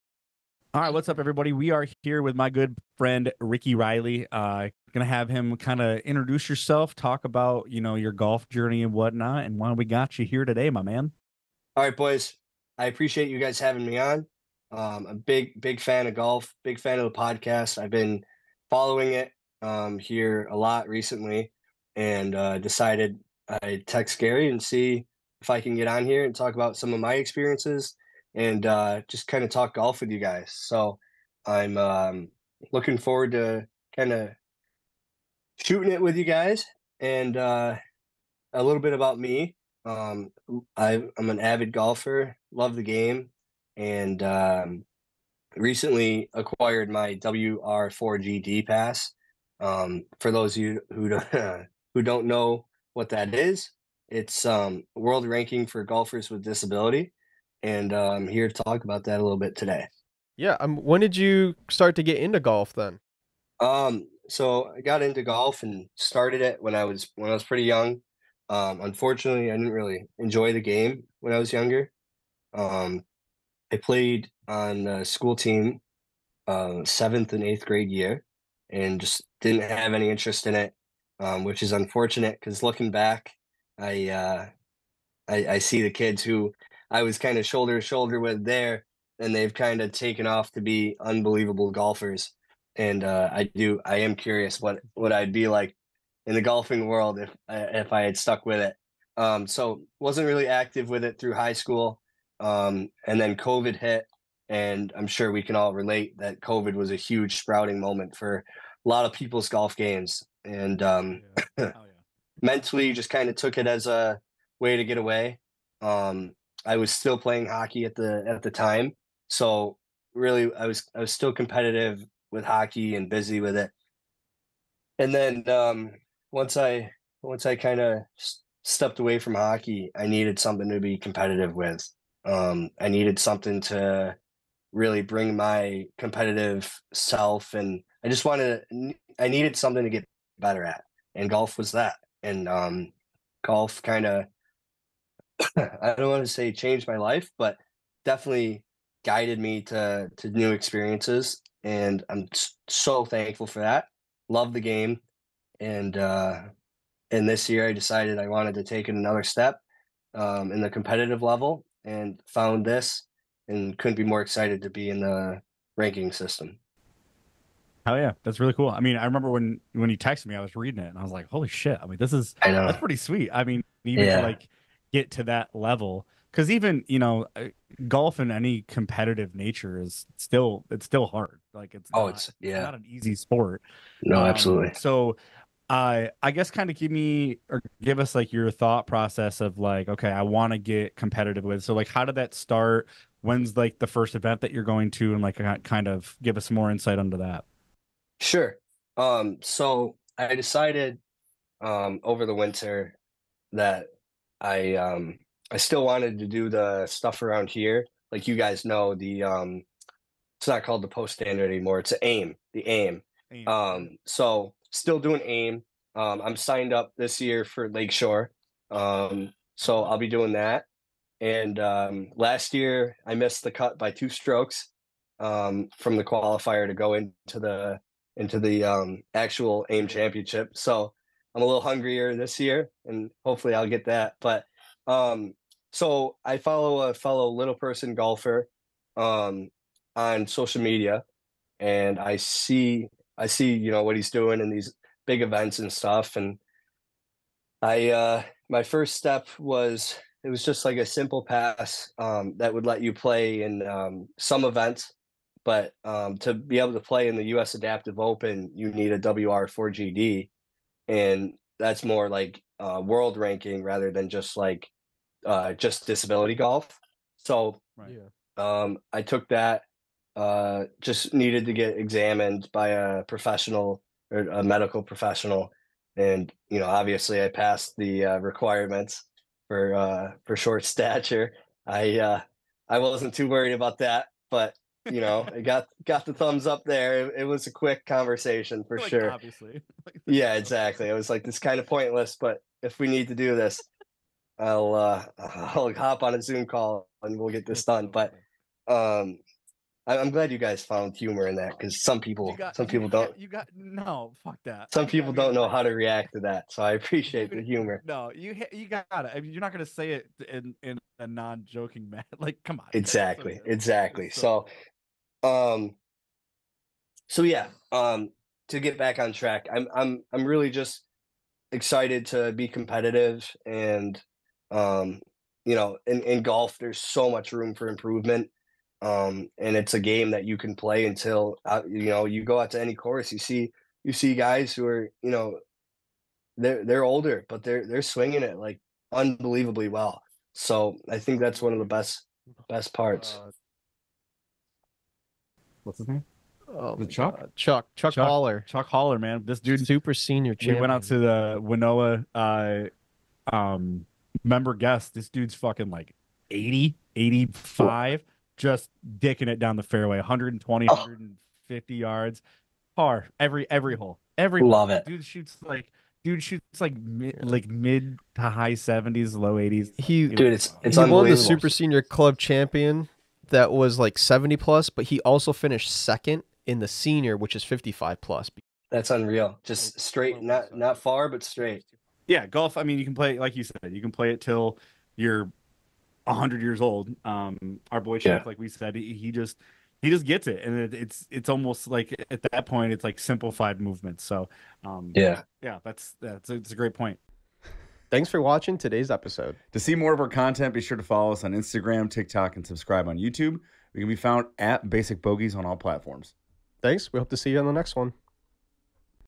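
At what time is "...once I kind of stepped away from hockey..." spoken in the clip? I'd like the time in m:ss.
2:07.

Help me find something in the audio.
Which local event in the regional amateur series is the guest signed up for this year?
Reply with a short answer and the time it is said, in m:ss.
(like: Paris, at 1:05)
Lakeshore, at 3:37.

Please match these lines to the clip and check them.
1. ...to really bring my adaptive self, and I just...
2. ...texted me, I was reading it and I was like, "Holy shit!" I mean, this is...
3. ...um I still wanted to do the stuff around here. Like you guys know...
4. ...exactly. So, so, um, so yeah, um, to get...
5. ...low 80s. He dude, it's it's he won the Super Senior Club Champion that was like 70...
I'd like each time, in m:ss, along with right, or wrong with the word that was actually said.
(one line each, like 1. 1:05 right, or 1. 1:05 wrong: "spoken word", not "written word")
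1. 2:13 wrong: "competitive", not "adaptive"
2. 2:49 right
3. 3:24 right
4. 5:13 right
5. 6:09 right.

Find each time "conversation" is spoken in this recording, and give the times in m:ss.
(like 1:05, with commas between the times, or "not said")
4:47.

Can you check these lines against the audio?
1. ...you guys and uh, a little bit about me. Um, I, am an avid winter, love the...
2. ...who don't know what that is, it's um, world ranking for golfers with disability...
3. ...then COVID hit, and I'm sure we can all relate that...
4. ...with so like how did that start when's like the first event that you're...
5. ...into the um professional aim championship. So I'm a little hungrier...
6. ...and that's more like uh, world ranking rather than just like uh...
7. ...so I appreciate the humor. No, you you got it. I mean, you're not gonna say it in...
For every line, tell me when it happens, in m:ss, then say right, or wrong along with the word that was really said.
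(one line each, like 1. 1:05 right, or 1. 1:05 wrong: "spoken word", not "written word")
1. 0:36 wrong: "golfer", not "winter"
2. 0:51 right
3. 1:43 right
4. 3:11 right
5. 3:48 wrong: "actual", not "professional"
6. 4:20 right
7. 5:06 right.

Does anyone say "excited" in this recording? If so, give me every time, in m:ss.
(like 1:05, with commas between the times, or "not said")
2:44, 5:21.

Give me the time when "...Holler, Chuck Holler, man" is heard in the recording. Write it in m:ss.
5:48.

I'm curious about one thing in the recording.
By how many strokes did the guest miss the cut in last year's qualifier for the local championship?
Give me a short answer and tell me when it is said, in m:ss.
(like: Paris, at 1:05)
2, at 3:43.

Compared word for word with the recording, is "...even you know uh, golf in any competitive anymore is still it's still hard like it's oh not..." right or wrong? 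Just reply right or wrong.
wrong.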